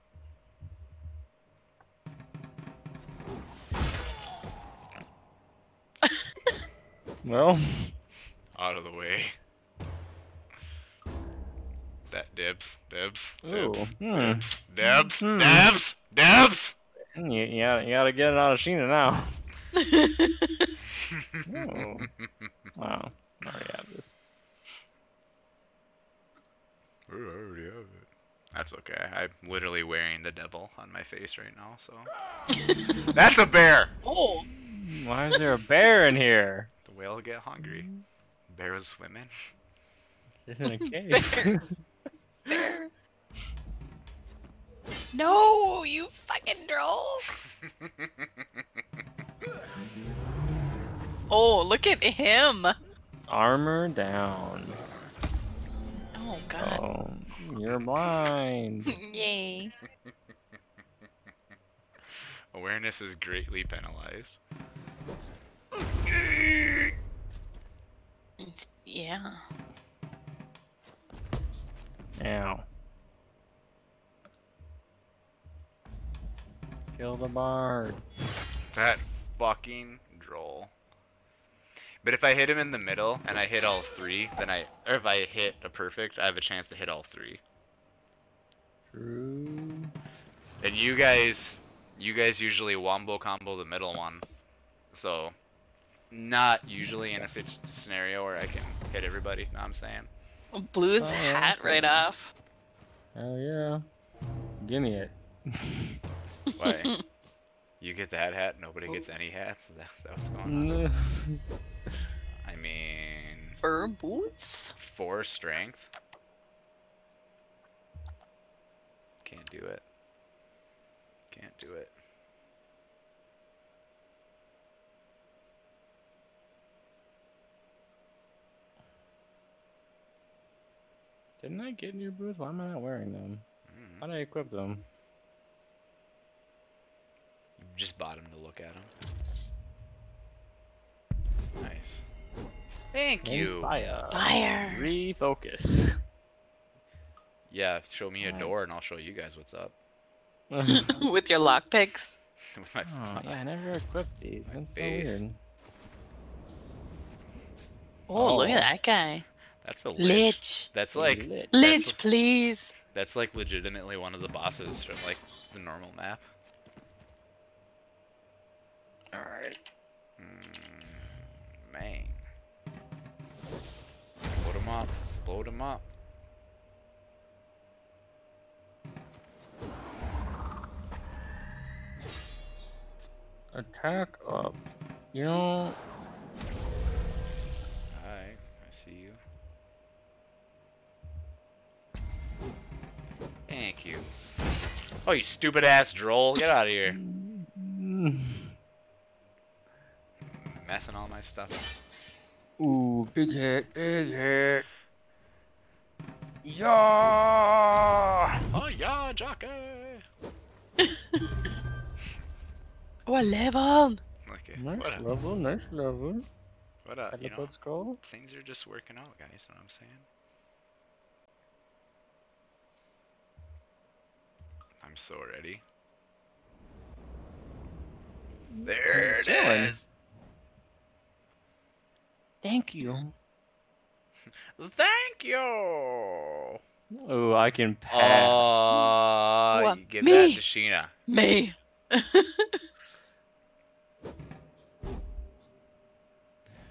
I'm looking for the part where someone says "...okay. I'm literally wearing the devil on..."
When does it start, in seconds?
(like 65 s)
28 s.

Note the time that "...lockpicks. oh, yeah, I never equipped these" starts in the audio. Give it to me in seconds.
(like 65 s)
151 s.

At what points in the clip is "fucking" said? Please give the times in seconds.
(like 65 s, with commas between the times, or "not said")
46 s, 79 s.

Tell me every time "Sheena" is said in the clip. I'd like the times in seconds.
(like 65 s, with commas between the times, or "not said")
18 s, 240 s.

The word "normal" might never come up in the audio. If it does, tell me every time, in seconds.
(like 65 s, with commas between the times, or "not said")
165 s.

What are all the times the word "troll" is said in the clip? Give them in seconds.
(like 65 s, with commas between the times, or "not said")
46 s.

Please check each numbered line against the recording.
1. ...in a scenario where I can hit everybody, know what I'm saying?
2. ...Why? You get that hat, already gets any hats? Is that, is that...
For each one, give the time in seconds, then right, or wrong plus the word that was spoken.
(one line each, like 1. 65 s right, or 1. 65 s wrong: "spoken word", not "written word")
1. 97 s right
2. 106 s wrong: "nobody", not "already".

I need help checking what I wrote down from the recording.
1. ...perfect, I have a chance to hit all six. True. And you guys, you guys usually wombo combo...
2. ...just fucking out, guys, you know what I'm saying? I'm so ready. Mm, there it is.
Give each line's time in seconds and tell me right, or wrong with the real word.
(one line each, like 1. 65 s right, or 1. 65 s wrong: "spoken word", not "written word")
1. 85 s wrong: "three", not "six"
2. 218 s wrong: "working", not "fucking".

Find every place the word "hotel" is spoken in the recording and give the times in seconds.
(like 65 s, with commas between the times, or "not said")
not said.